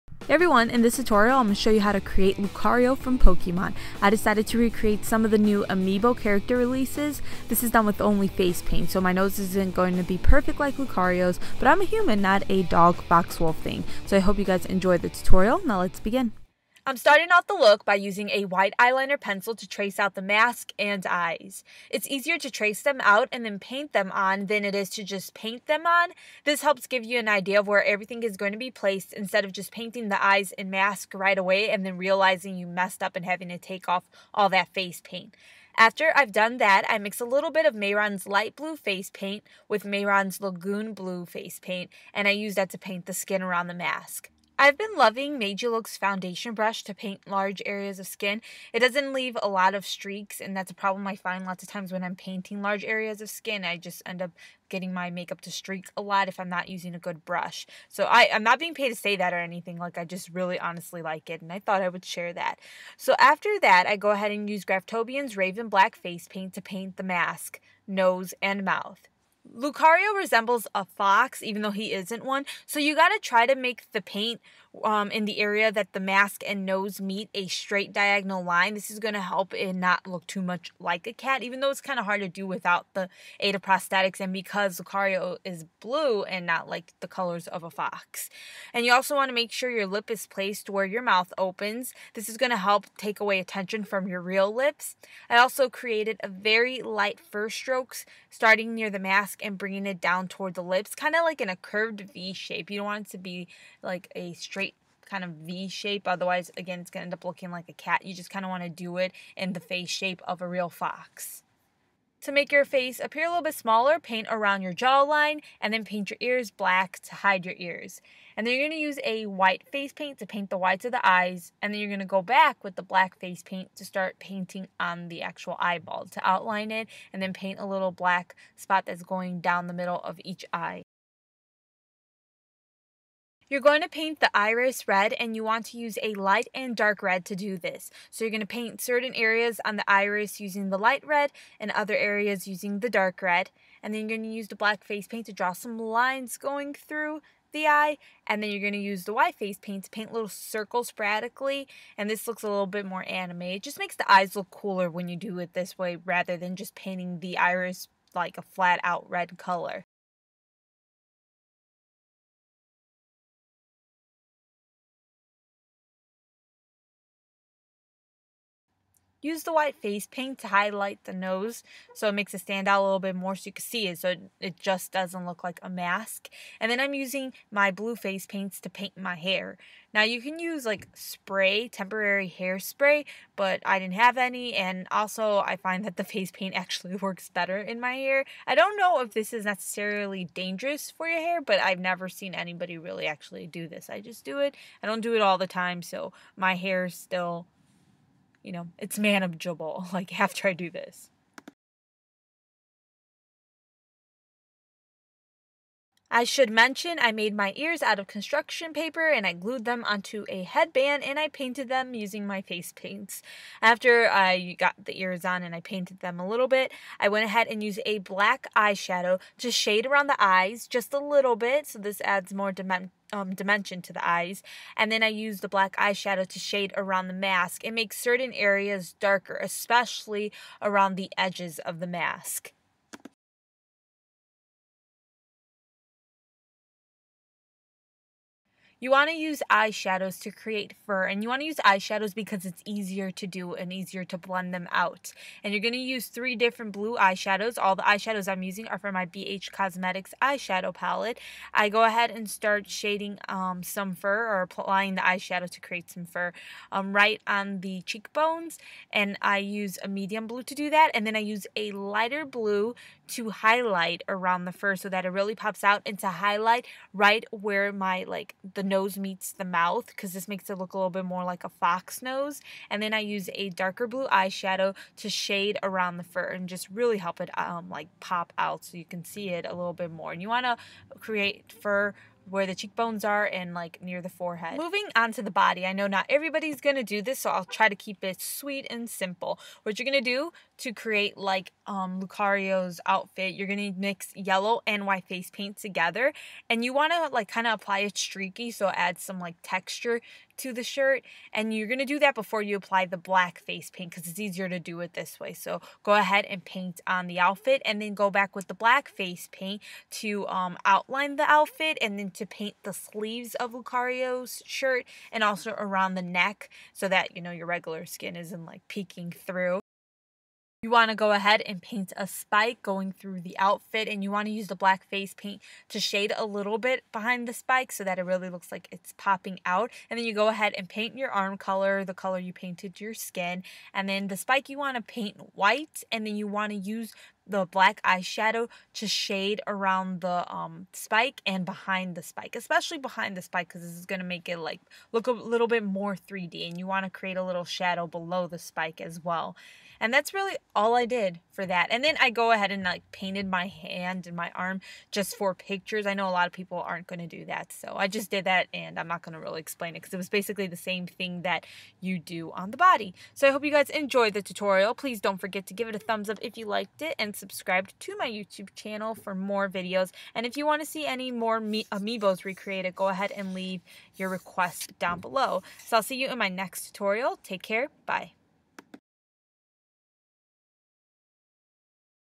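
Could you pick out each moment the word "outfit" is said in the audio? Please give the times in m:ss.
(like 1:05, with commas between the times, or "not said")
4:52, 5:07, 5:11, 5:23.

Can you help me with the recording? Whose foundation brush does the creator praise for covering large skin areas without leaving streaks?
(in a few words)
Meiji Look.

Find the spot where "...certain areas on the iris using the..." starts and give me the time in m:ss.
2:18.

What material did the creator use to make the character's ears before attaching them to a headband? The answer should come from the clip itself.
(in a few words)
construction paper.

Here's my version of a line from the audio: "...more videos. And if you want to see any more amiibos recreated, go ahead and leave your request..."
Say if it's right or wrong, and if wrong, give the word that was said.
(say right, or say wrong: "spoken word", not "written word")
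right.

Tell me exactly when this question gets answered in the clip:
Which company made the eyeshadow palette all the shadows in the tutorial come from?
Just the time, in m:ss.
4:09.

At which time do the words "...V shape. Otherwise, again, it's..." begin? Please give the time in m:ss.
1:45.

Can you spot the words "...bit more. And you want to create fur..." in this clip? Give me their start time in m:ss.
4:39.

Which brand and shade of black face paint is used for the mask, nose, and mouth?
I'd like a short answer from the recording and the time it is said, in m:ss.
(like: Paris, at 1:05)
Graftobian's Raven Black, at 1:04.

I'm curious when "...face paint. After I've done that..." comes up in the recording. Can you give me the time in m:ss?
0:34.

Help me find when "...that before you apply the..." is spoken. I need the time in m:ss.
5:01.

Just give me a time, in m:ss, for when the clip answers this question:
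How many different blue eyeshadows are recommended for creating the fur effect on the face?
4:06.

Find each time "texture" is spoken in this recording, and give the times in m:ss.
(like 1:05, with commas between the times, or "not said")
4:59.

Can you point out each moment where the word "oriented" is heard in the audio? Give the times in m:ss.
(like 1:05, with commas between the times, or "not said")
not said.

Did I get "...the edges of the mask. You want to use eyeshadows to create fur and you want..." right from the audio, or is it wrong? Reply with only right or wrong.
right.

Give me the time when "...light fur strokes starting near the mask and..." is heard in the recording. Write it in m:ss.
1:36.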